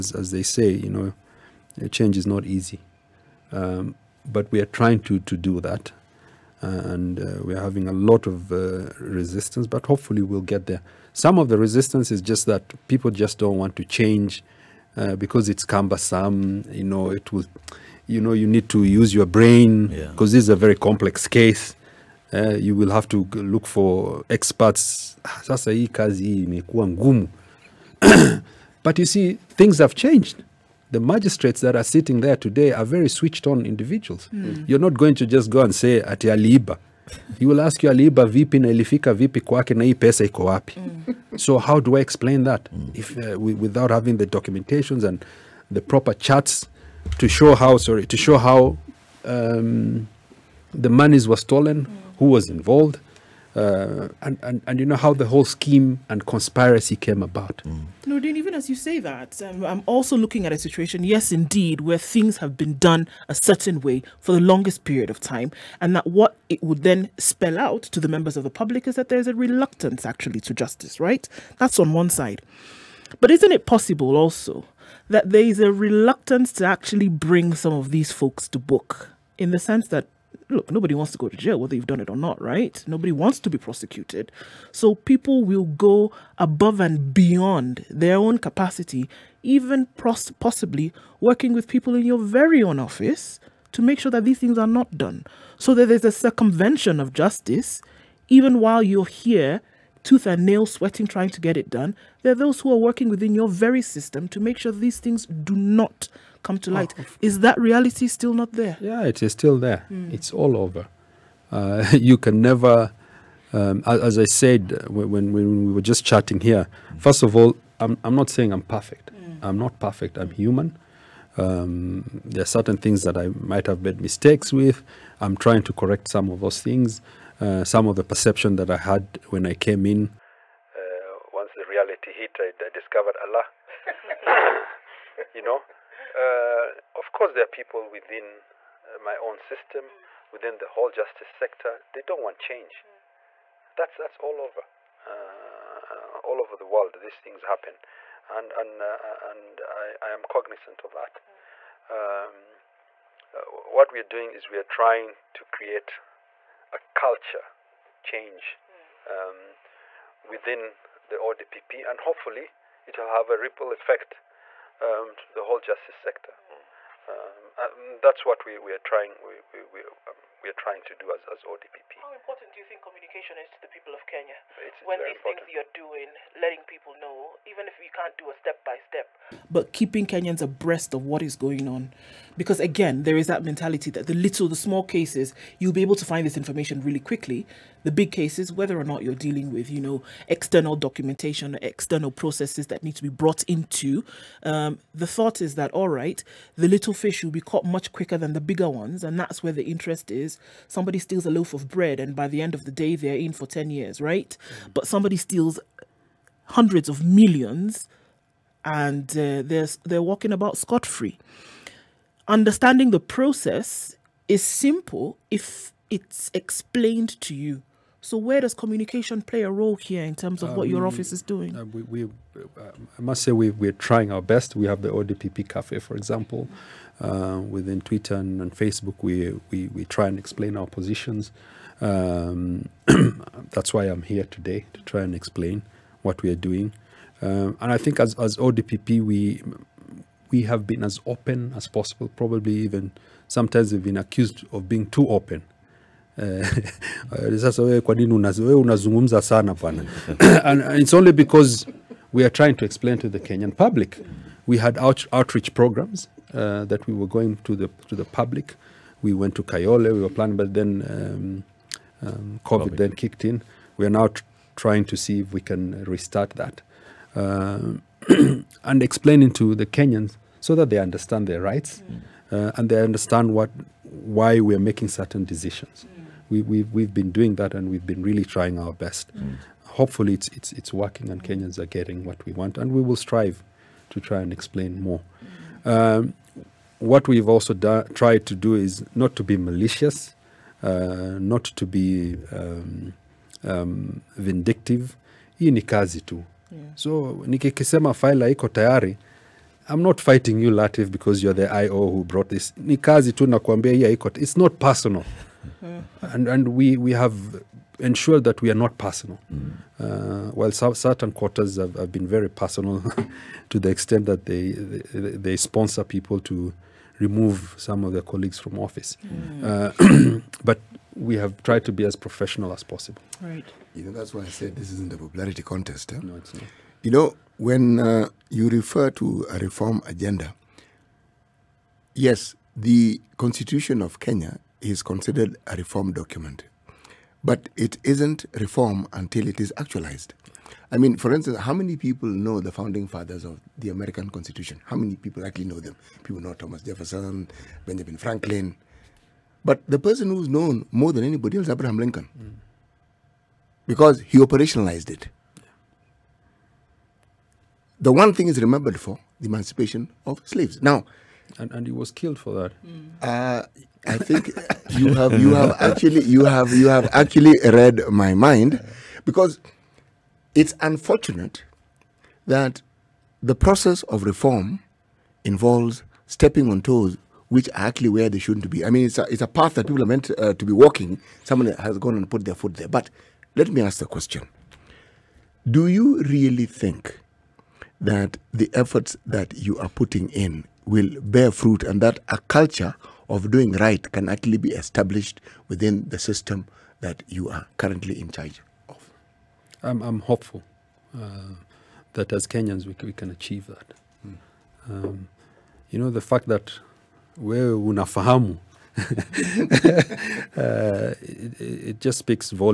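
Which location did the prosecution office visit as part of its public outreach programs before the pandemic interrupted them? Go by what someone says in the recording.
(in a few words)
Kayole.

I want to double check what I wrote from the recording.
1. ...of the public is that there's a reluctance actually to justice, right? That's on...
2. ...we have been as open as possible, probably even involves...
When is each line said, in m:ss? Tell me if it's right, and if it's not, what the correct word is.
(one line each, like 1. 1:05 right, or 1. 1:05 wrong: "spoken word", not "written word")
1. 1:08 right
2. 4:00 wrong: "sometimes", not "involves".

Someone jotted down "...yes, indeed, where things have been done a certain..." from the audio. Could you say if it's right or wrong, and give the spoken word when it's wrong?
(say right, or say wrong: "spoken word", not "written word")
right.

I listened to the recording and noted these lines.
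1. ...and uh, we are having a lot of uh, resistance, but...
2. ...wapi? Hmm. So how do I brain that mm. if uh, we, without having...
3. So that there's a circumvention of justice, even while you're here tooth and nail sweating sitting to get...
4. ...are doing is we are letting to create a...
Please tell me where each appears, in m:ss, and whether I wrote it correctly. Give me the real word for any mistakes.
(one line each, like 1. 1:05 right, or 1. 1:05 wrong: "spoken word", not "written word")
1. 0:06 right
2. 0:40 wrong: "explain", not "brain"
3. 1:35 wrong: "trying", not "sitting"
4. 2:33 wrong: "trying", not "letting".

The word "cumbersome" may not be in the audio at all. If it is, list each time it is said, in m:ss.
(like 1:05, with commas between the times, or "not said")
0:15.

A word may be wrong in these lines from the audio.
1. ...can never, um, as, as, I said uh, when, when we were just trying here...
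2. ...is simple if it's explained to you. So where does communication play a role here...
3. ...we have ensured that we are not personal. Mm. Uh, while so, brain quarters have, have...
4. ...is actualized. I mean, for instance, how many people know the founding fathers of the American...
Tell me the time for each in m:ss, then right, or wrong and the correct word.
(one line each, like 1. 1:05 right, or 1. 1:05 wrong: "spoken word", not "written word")
1. 1:52 wrong: "chatting", not "trying"
2. 3:34 right
3. 5:06 wrong: "certain", not "brain"
4. 5:39 right.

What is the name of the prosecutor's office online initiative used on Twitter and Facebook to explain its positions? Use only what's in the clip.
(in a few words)
ODPP Cafe.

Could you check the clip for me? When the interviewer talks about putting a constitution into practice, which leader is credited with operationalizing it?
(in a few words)
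Abraham Lincoln.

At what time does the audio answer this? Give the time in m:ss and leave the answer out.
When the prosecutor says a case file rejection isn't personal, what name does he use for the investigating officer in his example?
5:00.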